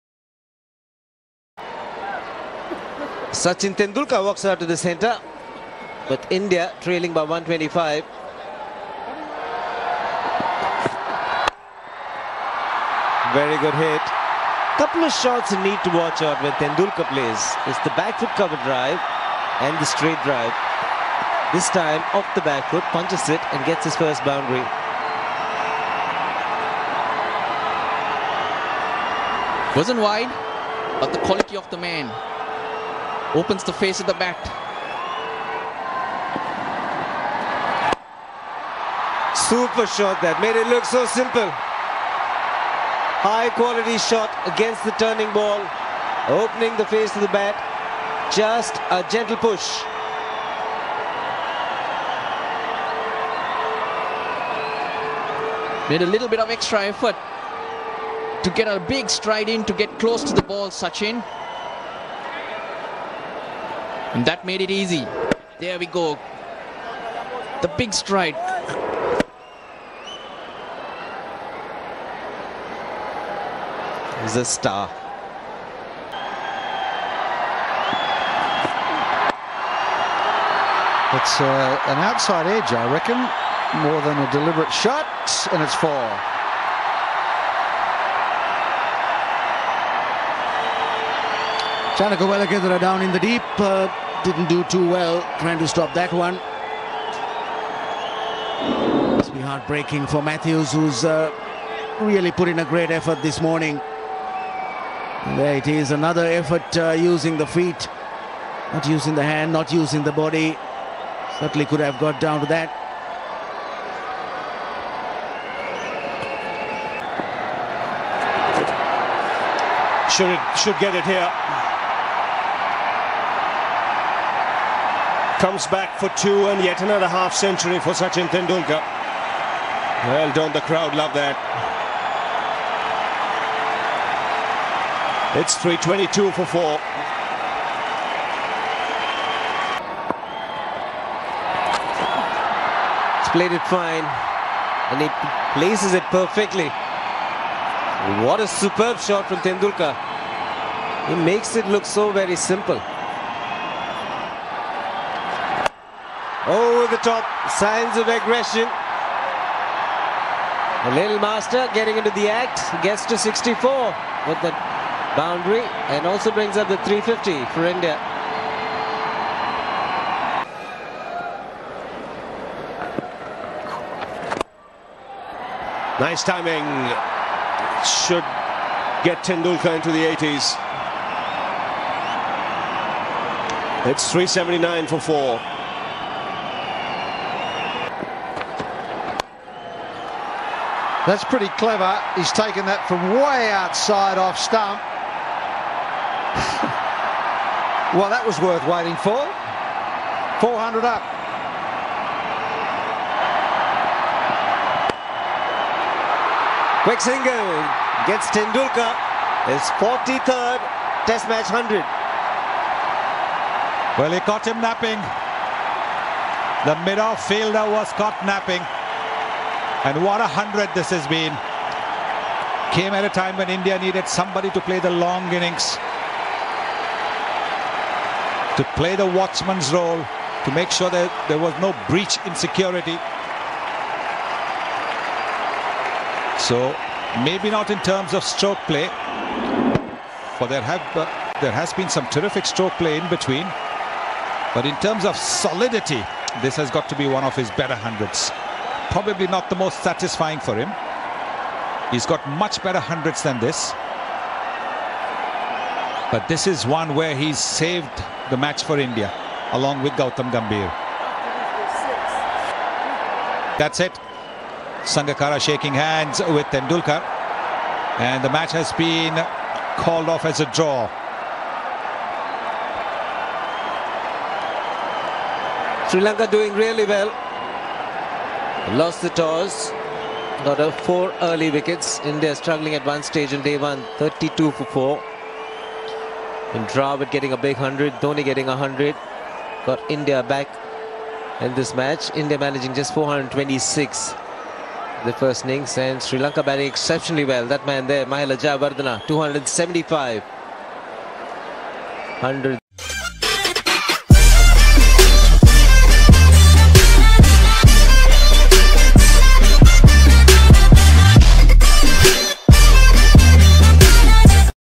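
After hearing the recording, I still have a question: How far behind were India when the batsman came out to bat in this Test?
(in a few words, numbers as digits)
125.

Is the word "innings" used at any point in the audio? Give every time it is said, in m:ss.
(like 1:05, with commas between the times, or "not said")
3:45, 4:55.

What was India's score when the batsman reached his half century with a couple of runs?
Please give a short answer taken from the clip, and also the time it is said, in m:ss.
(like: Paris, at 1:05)
322 for 4, at 2:15.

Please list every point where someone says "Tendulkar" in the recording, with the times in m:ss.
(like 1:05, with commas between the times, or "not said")
0:03, 0:16, 2:08, 2:29, 2:59, 3:28, 4:26.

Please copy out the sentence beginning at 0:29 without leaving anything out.
Wasn't wide, but the quality of the man Opens the face of the bat.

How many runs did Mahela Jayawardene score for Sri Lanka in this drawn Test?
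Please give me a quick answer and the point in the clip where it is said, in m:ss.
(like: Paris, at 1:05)
275, at 4:59.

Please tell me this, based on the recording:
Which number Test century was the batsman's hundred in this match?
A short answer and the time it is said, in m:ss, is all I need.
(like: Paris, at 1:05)
43rd, at 3:29.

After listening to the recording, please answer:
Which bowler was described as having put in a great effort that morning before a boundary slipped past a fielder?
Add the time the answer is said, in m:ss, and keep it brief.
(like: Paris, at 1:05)
Mathews, at 1:40.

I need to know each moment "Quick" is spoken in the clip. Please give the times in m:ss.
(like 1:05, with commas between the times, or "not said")
3:26.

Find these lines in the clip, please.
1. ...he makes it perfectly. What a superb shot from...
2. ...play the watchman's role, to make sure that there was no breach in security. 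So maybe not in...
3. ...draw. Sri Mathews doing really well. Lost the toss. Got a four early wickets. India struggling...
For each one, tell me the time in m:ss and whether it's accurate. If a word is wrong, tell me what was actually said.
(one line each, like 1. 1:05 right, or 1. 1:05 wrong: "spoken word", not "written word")
1. 2:25 wrong: "places", not "makes"
2. 3:48 right
3. 4:30 wrong: "Lanka", not "Mathews".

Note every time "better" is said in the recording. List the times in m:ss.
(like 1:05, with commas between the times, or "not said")
4:07, 4:12.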